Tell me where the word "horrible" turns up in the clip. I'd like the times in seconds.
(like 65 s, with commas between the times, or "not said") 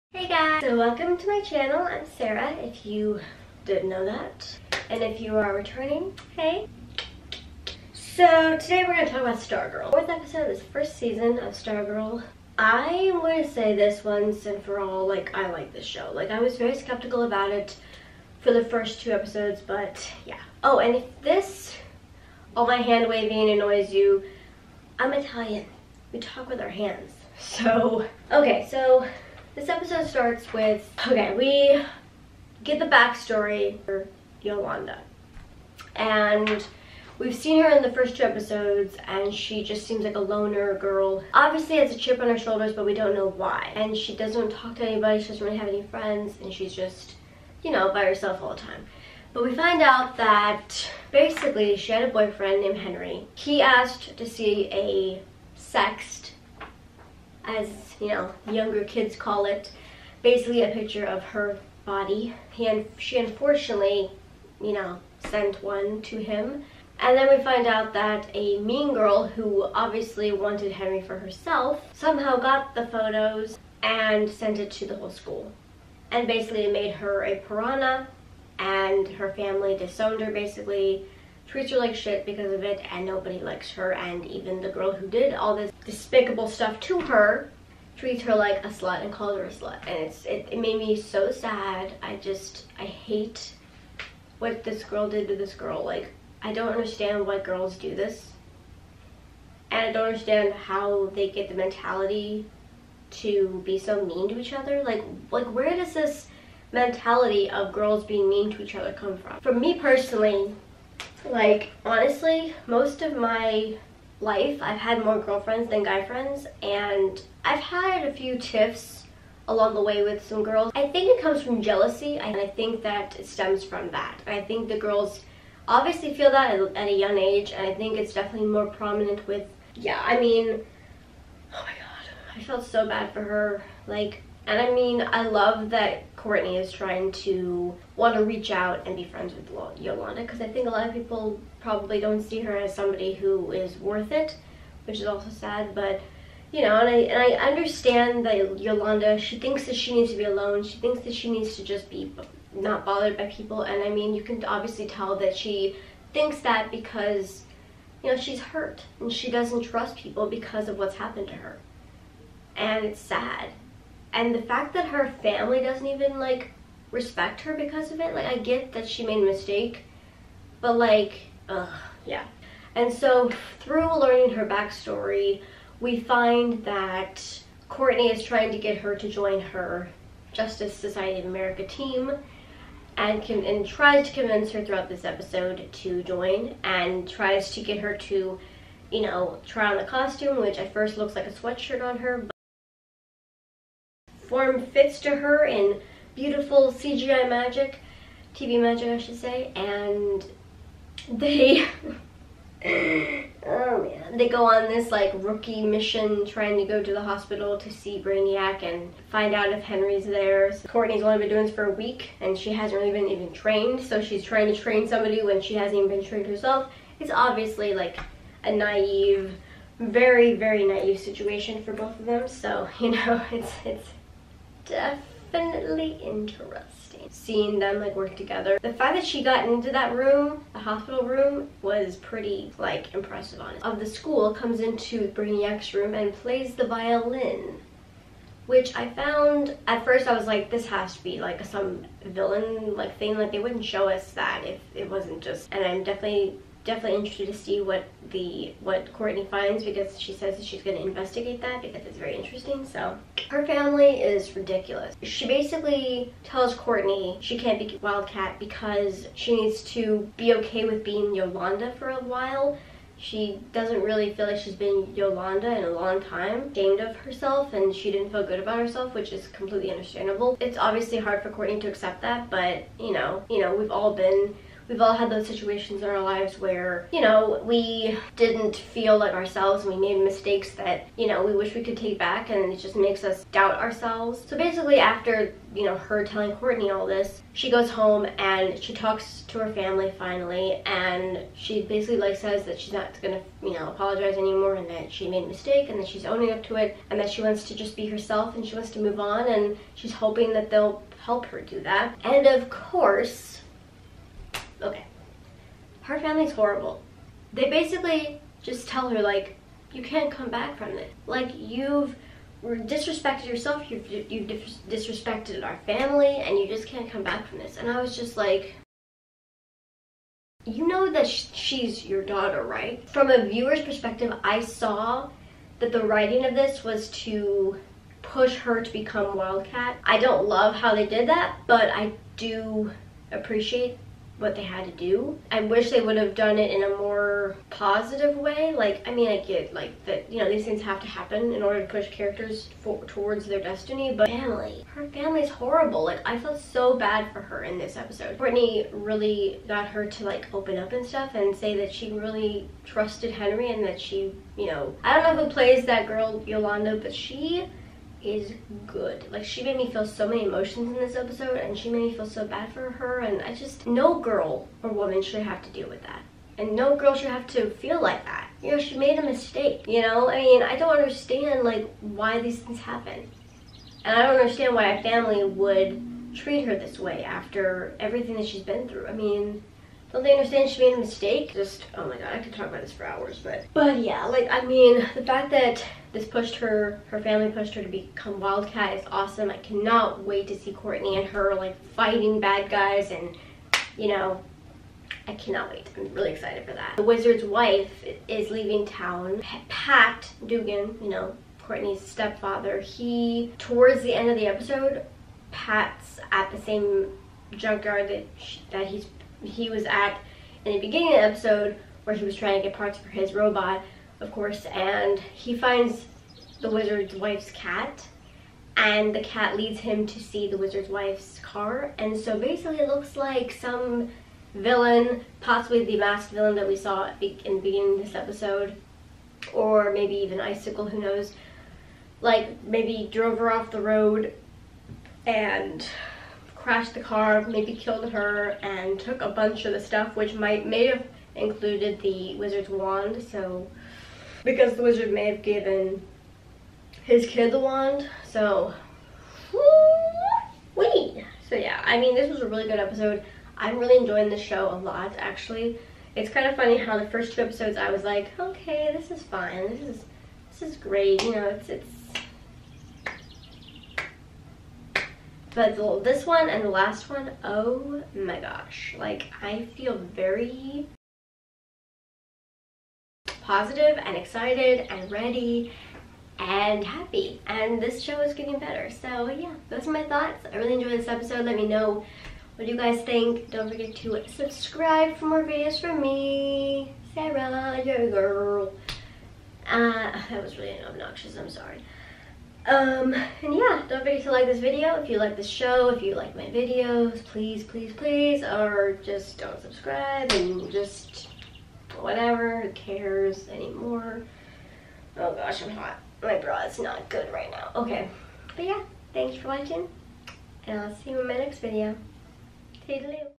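306 s, 345 s.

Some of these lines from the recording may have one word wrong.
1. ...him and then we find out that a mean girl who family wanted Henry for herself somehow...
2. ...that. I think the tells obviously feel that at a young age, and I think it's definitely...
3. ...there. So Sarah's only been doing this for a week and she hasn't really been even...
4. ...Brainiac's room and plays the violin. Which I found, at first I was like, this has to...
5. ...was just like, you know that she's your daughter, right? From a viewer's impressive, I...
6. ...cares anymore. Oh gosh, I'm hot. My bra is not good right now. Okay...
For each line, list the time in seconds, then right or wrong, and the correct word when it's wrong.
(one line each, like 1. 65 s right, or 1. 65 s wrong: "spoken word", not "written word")
1. 66 s wrong: "obviously", not "family"
2. 123 s wrong: "girls", not "tells"
3. 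210 s wrong: "Courtney", not "Sarah"
4. 235 s right
5. 317 s wrong: "perspective", not "impressive"
6. 502 s right.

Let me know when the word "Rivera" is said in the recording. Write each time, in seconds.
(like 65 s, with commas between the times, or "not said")
not said.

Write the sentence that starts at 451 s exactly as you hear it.
So yeah, I mean this was a really good episode.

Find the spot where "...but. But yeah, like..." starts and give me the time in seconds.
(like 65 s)
383 s.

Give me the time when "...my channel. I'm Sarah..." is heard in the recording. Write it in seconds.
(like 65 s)
1 s.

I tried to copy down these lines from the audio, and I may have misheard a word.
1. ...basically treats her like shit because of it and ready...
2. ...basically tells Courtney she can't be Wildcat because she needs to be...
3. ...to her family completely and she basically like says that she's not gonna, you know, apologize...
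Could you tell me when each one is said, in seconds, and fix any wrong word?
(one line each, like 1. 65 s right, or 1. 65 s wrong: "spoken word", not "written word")
1. 80 s wrong: "nobody", not "ready"
2. 255 s right
3. 289 s wrong: "finally", not "completely".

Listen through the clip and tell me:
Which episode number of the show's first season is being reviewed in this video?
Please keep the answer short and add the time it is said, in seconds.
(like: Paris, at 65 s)
Fourth, at 9 s.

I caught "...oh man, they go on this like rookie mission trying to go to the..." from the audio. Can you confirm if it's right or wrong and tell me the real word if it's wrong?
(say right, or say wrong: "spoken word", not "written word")
right.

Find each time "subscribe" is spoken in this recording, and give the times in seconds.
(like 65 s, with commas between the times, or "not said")
484 s, 499 s.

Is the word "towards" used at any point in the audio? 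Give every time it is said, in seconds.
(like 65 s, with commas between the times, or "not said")
342 s, 403 s.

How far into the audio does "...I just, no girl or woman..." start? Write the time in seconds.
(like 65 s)
363 s.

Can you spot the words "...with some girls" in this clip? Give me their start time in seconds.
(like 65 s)
120 s.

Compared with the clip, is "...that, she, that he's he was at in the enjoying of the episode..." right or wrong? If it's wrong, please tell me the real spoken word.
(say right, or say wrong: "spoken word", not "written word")
wrong: "beginning", not "enjoying".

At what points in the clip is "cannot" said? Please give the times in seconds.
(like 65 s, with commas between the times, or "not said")
389 s, 395 s.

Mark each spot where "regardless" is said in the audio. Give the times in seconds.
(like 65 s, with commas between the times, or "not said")
not said.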